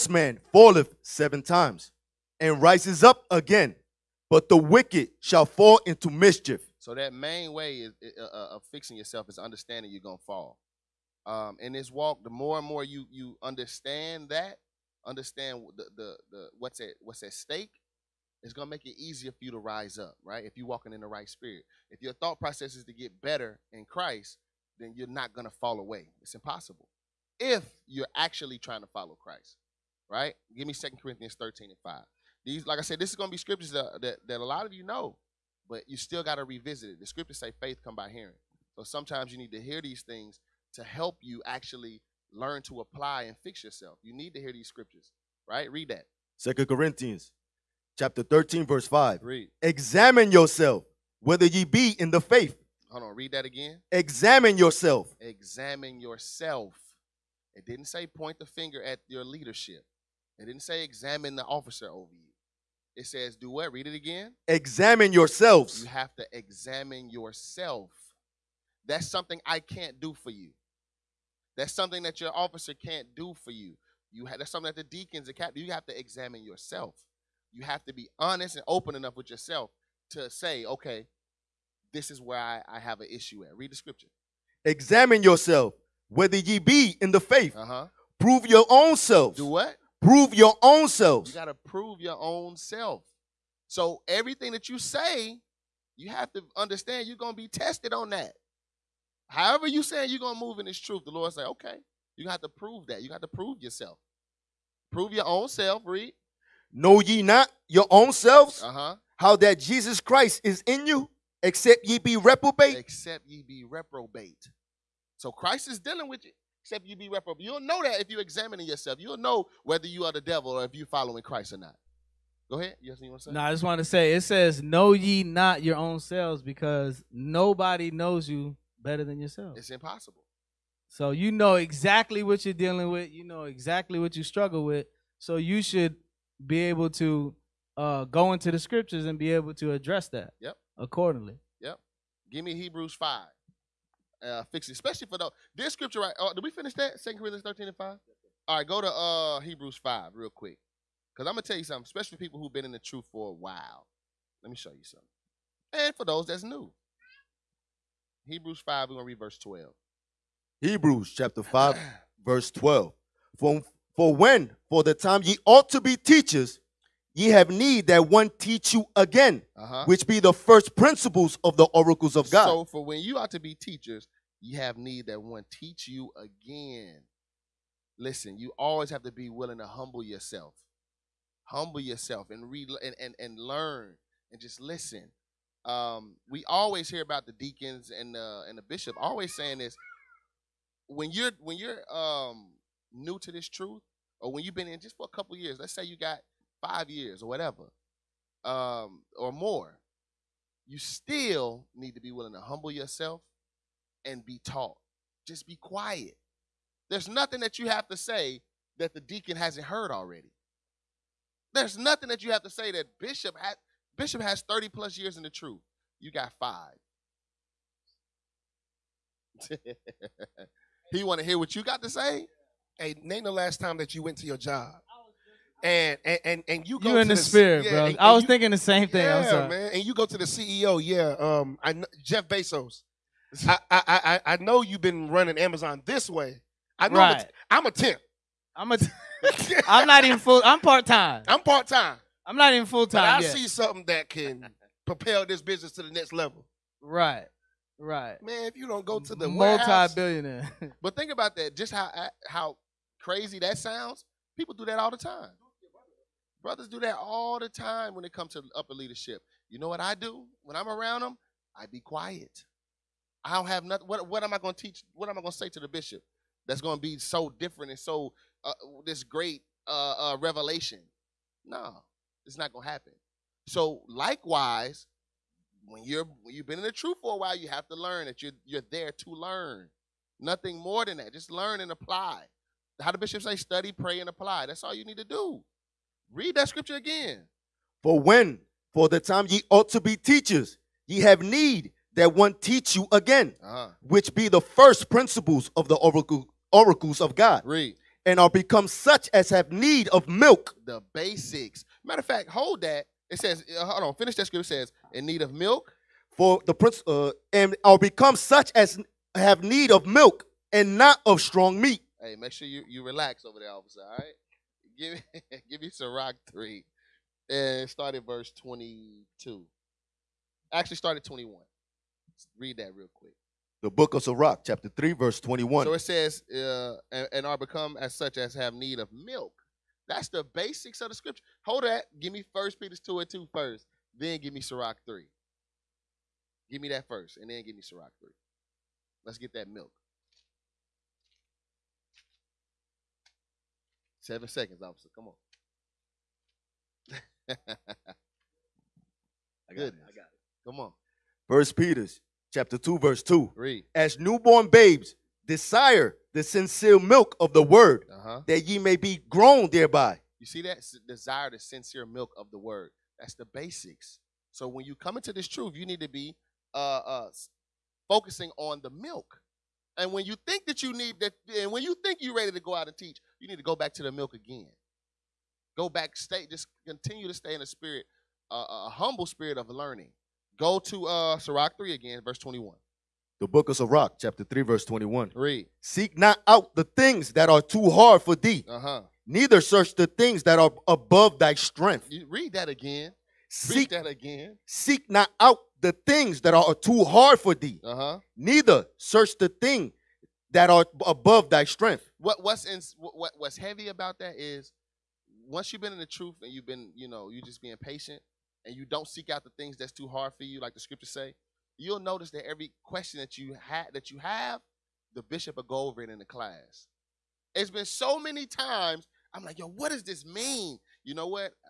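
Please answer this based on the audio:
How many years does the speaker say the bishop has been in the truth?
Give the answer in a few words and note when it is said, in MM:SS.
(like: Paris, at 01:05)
30 plus years, at 03:34.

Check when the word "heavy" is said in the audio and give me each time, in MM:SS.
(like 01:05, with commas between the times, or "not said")
06:43.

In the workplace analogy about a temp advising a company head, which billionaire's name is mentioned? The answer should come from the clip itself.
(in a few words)
Jeff Bezos.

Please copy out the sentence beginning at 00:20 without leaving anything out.
If you're walking in the right spirit.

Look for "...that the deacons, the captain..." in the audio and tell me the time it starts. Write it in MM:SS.
01:14.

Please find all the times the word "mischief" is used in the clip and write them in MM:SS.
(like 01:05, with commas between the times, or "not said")
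00:06.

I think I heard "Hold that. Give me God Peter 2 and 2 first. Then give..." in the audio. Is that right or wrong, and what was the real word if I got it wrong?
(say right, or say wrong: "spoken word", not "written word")
wrong: "First", not "God".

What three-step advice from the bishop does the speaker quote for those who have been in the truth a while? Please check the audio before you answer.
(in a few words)
study, pray, and apply.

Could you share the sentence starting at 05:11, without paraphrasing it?
Hey, make sure you, you relax over there, officer, all right?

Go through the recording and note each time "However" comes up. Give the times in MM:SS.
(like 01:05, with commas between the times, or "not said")
01:39.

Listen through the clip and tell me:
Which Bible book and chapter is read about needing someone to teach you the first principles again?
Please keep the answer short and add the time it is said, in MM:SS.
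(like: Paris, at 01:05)
Hebrews 5, at 02:40.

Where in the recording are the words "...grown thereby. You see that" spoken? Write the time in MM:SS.
05:59.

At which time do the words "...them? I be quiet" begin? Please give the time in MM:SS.
04:21.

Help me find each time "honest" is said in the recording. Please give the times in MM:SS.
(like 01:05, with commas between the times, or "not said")
01:18.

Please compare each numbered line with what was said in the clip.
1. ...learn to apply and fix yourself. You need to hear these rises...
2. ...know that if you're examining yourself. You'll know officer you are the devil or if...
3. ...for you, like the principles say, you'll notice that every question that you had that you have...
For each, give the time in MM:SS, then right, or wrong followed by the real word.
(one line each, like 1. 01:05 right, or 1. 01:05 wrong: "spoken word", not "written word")
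1. 00:42 wrong: "scriptures", not "rises"
2. 01:57 wrong: "whether", not "officer"
3. 06:50 wrong: "scriptures", not "principles".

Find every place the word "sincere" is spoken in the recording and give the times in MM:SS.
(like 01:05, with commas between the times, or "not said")
05:56, 06:01.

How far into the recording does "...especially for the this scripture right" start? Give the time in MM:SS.
02:24.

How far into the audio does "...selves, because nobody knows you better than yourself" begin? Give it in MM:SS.
02:05.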